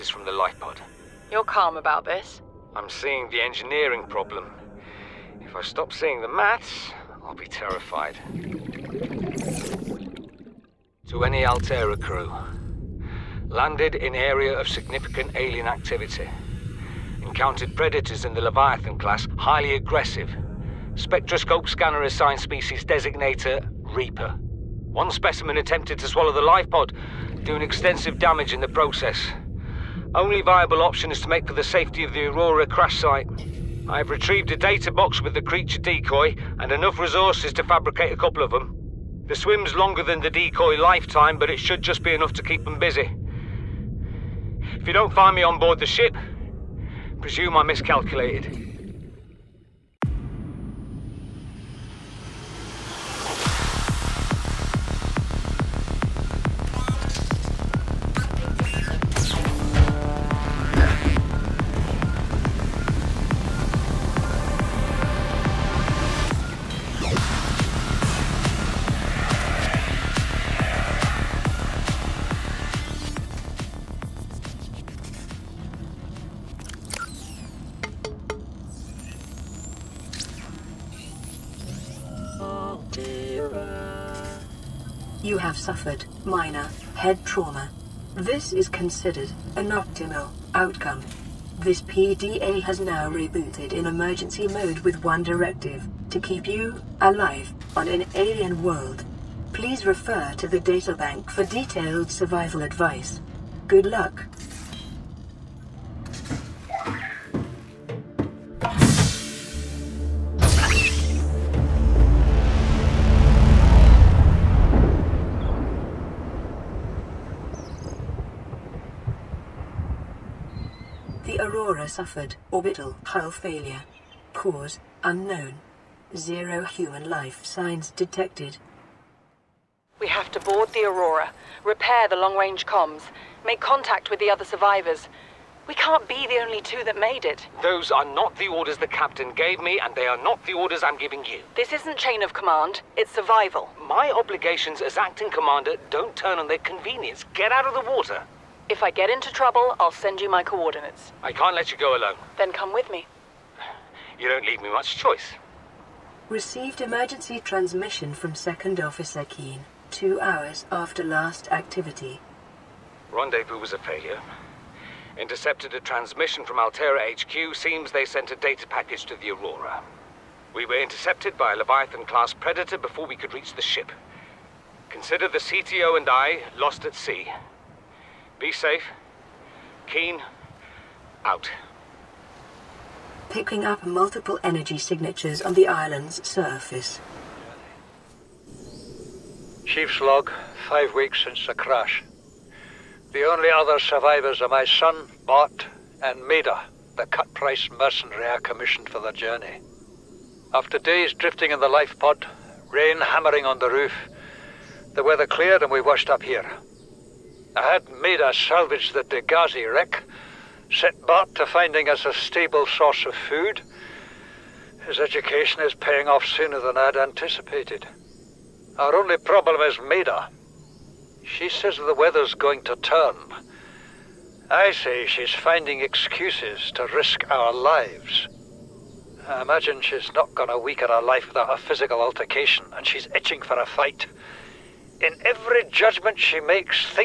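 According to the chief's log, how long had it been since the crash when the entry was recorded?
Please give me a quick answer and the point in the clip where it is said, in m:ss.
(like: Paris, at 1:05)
5 weeks, at 3:10.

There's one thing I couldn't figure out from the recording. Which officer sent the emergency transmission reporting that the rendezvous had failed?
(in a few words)
Second Officer Keen.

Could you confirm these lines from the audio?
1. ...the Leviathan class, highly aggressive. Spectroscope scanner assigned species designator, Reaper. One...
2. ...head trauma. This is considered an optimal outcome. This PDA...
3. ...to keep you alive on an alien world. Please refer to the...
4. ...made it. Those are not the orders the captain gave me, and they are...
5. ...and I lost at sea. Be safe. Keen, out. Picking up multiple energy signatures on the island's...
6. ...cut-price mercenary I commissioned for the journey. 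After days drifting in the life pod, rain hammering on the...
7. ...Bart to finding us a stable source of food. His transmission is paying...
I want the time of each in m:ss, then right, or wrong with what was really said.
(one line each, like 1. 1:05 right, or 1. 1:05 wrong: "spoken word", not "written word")
1. 0:18 right
2. 1:26 right
3. 1:36 right
4. 2:17 right
5. 2:55 right
6. 3:17 right
7. 3:31 wrong: "education", not "transmission".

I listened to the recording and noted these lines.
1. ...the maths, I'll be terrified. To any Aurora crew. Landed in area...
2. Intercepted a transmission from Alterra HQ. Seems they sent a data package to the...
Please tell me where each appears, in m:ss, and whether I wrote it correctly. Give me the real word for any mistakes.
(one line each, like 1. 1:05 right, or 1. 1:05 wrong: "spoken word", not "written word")
1. 0:06 wrong: "Alterra", not "Aurora"
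2. 2:45 right.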